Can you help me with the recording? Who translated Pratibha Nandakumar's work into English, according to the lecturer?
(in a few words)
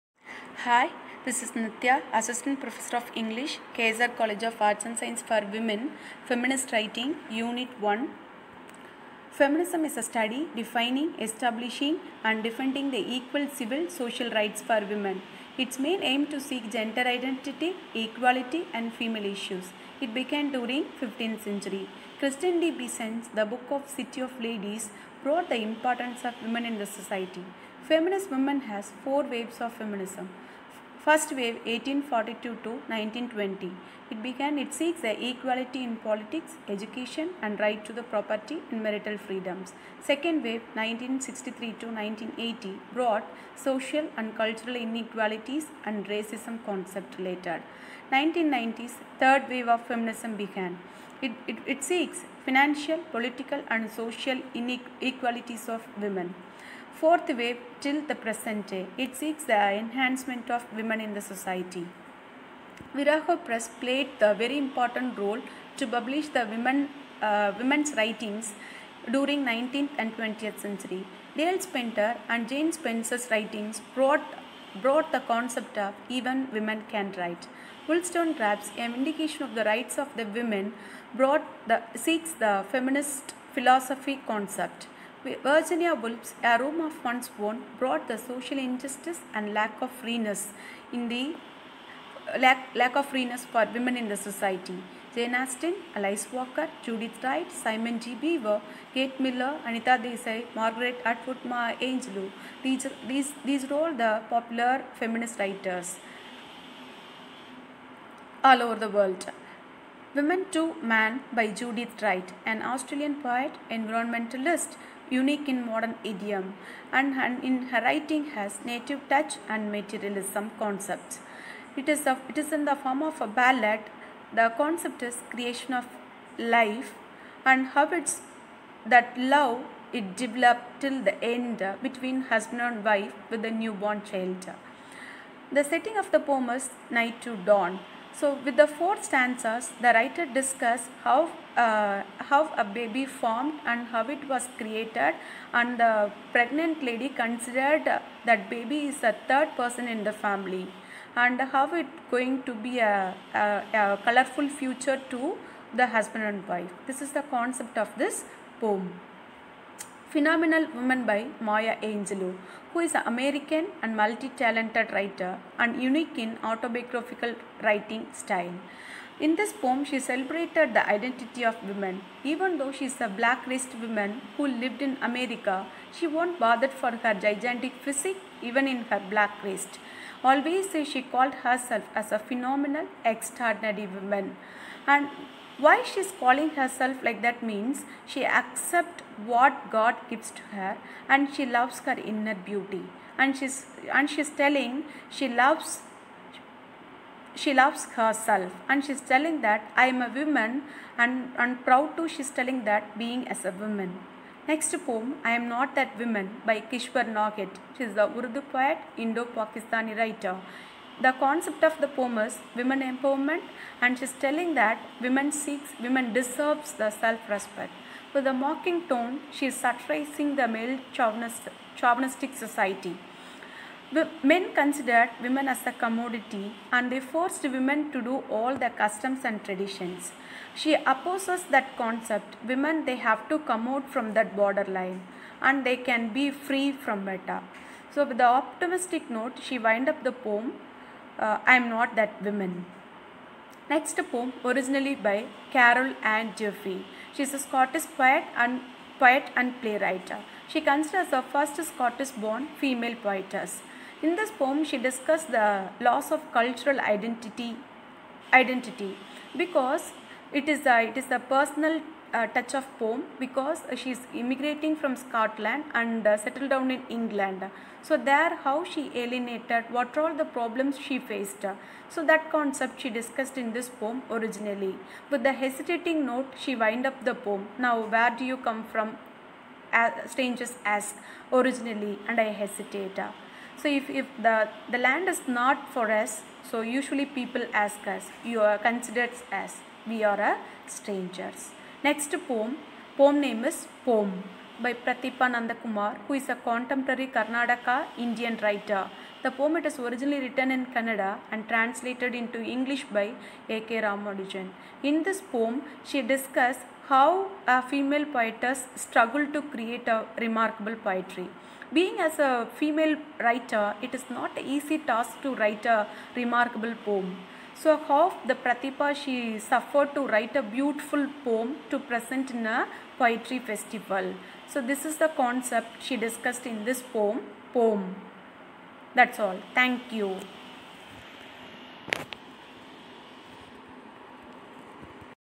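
A.K. Ramanujan.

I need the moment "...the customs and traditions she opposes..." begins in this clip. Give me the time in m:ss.
3:48.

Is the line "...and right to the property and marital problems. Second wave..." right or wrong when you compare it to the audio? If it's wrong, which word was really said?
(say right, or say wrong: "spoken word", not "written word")
wrong: "freedoms", not "problems".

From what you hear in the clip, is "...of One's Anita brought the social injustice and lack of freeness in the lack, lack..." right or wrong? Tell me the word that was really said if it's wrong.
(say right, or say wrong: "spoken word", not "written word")
wrong: "Own", not "Anita".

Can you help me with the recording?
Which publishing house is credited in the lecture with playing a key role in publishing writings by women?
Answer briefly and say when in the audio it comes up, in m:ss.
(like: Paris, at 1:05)
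Virago Press, at 1:02.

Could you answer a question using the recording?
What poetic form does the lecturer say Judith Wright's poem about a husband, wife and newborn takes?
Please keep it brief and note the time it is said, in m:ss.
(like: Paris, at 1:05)
Ballad, at 2:03.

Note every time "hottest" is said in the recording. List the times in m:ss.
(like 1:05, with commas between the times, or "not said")
not said.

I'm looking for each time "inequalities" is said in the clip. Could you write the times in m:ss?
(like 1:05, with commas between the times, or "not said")
0:44, 0:54.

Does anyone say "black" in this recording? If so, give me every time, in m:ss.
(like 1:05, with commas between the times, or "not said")
2:53, 2:59.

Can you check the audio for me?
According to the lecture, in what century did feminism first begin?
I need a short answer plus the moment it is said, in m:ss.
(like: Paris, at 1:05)
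15th century, at 0:21.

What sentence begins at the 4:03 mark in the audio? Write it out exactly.
Next poem, originally by Carol Ann Jeffrey.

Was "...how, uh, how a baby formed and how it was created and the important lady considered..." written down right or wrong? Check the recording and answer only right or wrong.
wrong.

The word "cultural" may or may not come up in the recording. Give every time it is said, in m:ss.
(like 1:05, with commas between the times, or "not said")
0:44, 4:16.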